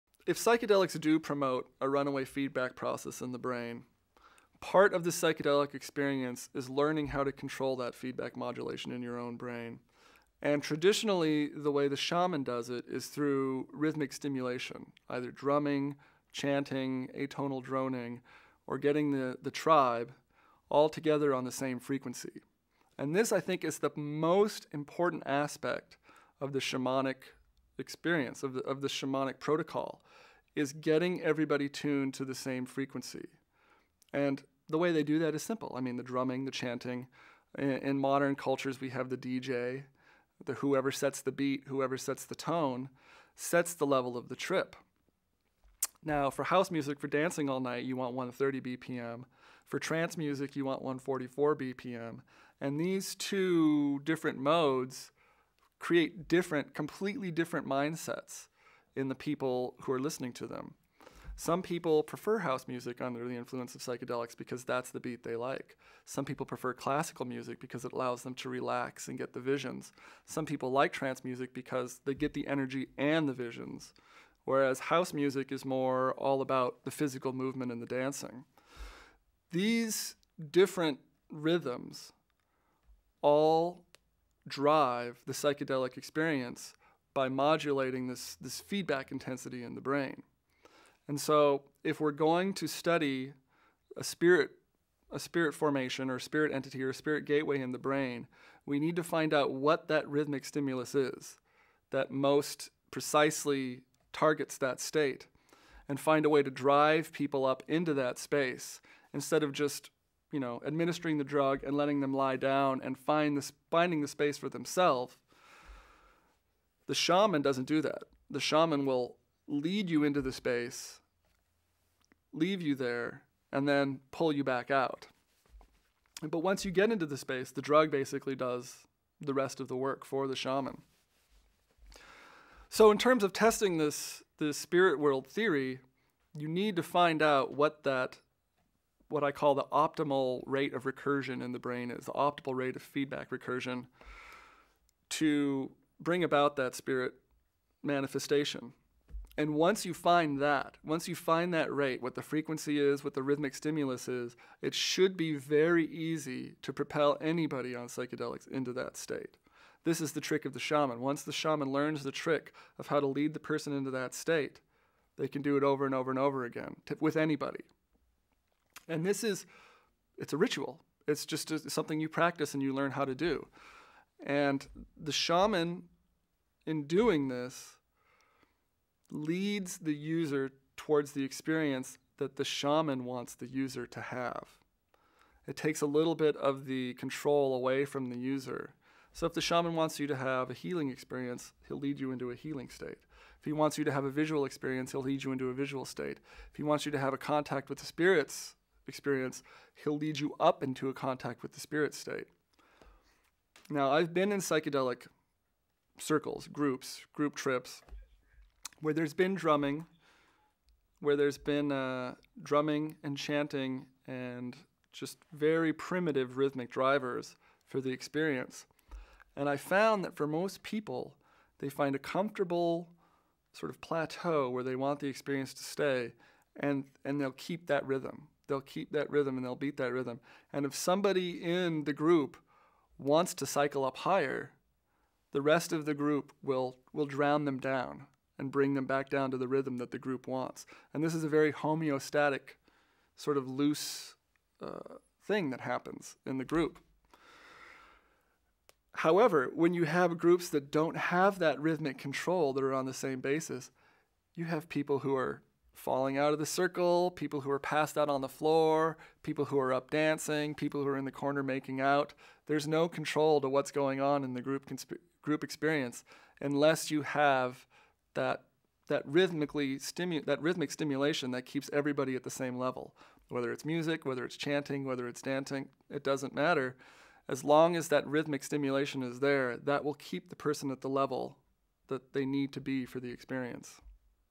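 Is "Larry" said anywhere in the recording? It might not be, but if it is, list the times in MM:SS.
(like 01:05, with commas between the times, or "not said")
not said.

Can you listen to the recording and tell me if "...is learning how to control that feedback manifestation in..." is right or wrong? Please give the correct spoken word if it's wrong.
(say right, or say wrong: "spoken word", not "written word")
wrong: "modulation", not "manifestation".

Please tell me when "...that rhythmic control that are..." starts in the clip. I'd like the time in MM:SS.
04:11.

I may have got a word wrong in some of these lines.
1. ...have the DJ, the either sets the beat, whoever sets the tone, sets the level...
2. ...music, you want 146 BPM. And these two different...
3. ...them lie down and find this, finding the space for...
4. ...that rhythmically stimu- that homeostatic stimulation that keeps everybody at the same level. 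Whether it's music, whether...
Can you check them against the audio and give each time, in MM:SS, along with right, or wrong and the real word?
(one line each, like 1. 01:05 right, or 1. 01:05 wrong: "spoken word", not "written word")
1. 00:38 wrong: "whoever", not "either"
2. 00:50 wrong: "144", not "146"
3. 01:51 right
4. 04:28 wrong: "rhythmic", not "homeostatic".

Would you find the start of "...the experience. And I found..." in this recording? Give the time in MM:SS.
03:37.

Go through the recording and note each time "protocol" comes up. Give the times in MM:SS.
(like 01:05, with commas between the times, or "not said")
00:29.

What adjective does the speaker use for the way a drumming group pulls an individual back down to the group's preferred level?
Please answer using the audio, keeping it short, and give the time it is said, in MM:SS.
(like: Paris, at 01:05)
homeostatic, at 04:01.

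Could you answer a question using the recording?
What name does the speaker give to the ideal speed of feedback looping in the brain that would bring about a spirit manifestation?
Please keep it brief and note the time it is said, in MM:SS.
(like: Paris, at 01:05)
optimal rate of recursion, at 02:19.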